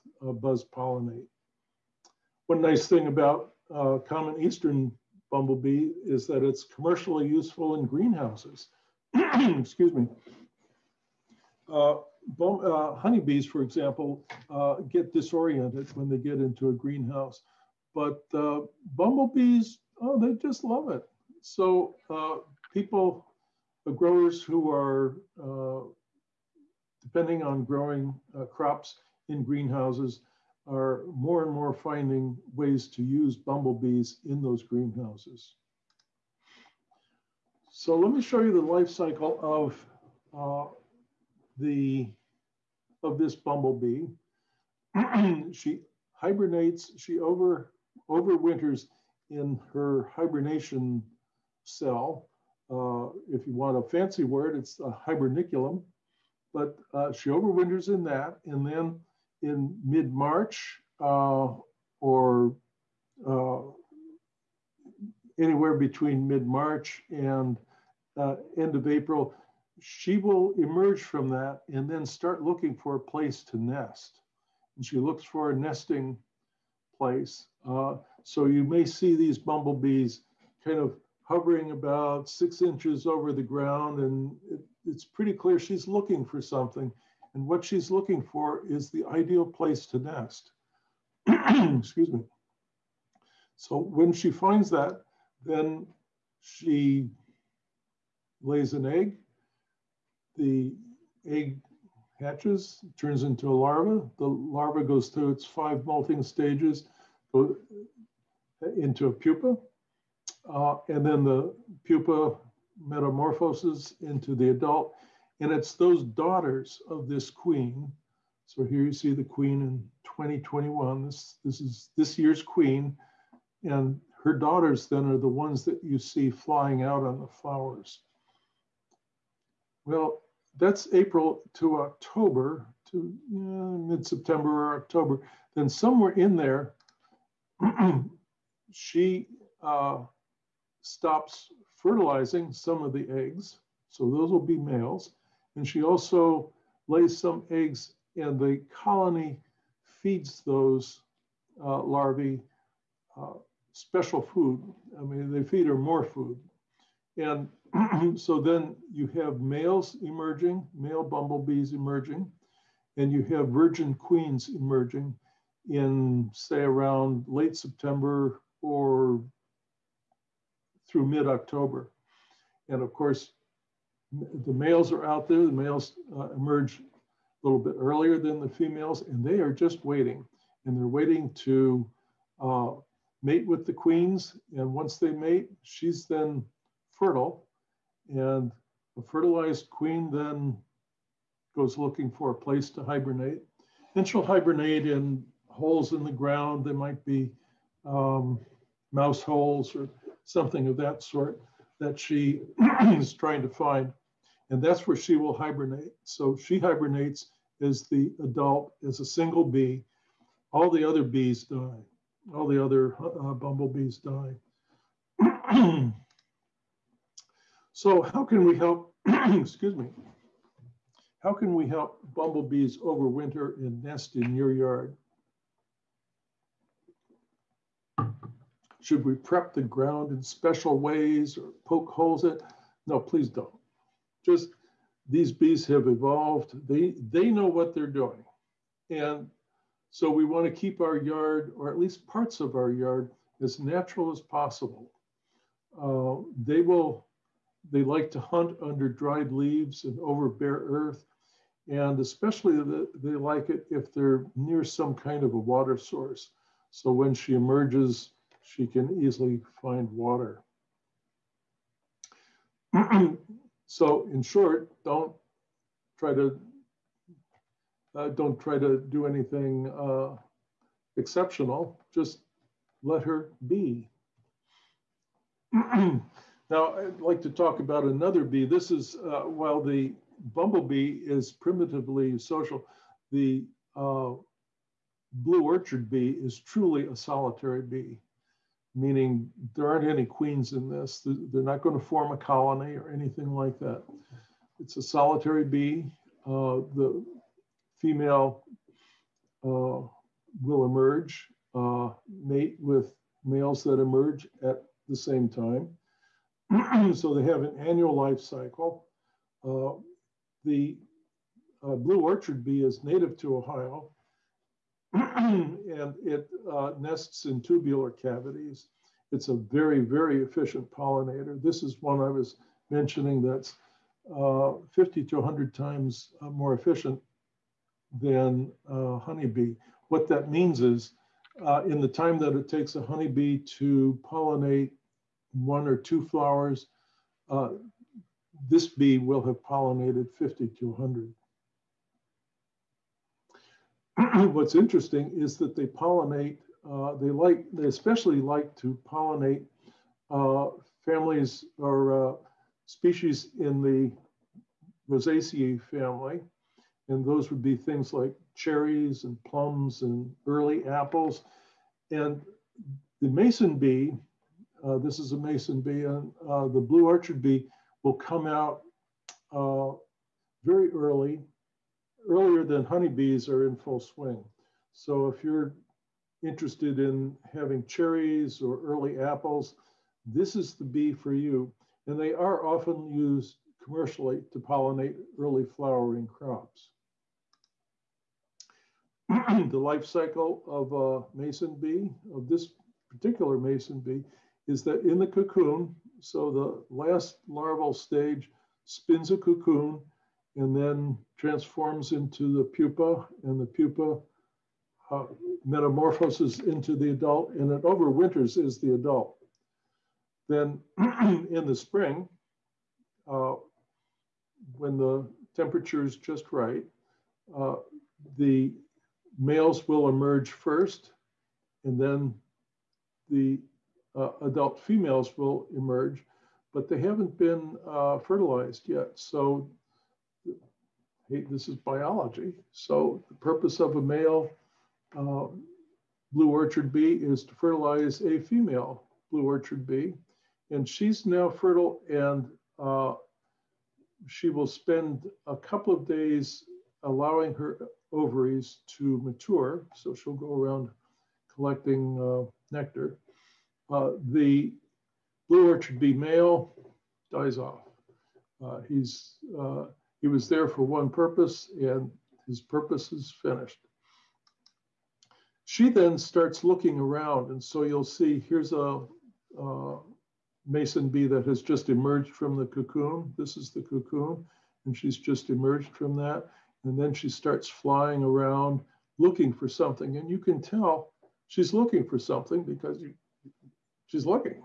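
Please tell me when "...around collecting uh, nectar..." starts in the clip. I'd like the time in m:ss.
7:30.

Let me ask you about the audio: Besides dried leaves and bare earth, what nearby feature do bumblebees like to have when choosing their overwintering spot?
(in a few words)
a water source.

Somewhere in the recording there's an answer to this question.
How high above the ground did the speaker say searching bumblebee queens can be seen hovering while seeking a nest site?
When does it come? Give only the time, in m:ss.
1:22.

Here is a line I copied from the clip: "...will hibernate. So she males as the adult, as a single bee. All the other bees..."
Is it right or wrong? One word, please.
wrong.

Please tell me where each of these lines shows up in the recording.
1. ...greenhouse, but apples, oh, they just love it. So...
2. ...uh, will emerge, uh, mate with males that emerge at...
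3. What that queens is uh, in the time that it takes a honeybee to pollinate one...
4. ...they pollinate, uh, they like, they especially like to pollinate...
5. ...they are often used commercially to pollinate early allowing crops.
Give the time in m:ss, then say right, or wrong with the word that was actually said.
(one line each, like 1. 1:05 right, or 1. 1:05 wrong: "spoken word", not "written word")
1. 0:16 wrong: "bumblebees", not "apples"
2. 4:59 right
3. 5:29 wrong: "means", not "queens"
4. 5:45 right
5. 6:21 wrong: "flowering", not "allowing".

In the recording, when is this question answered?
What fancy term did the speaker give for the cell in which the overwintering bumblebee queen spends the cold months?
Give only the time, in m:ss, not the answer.
0:55.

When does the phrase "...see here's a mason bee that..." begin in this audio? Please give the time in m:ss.
7:47.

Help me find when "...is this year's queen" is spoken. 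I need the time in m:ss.
2:01.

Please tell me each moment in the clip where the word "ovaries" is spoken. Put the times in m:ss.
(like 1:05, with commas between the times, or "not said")
7:27.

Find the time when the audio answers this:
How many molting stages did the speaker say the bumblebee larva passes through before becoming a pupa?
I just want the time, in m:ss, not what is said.
1:45.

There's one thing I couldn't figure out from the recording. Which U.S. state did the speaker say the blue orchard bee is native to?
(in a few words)
Ohio.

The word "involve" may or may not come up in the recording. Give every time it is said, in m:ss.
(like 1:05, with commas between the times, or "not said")
not said.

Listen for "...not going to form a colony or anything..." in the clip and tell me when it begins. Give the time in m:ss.
4:51.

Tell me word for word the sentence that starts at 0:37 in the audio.
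So let me show you the life cycle of uh, the of this bumblebee.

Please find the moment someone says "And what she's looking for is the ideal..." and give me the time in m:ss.
1:27.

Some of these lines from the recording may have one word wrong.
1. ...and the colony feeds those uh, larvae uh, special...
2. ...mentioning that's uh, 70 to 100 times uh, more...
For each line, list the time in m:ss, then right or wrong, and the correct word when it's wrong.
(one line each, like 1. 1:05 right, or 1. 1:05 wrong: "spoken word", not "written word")
1. 2:28 right
2. 5:22 wrong: "50", not "70".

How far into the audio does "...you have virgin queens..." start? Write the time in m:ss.
2:43.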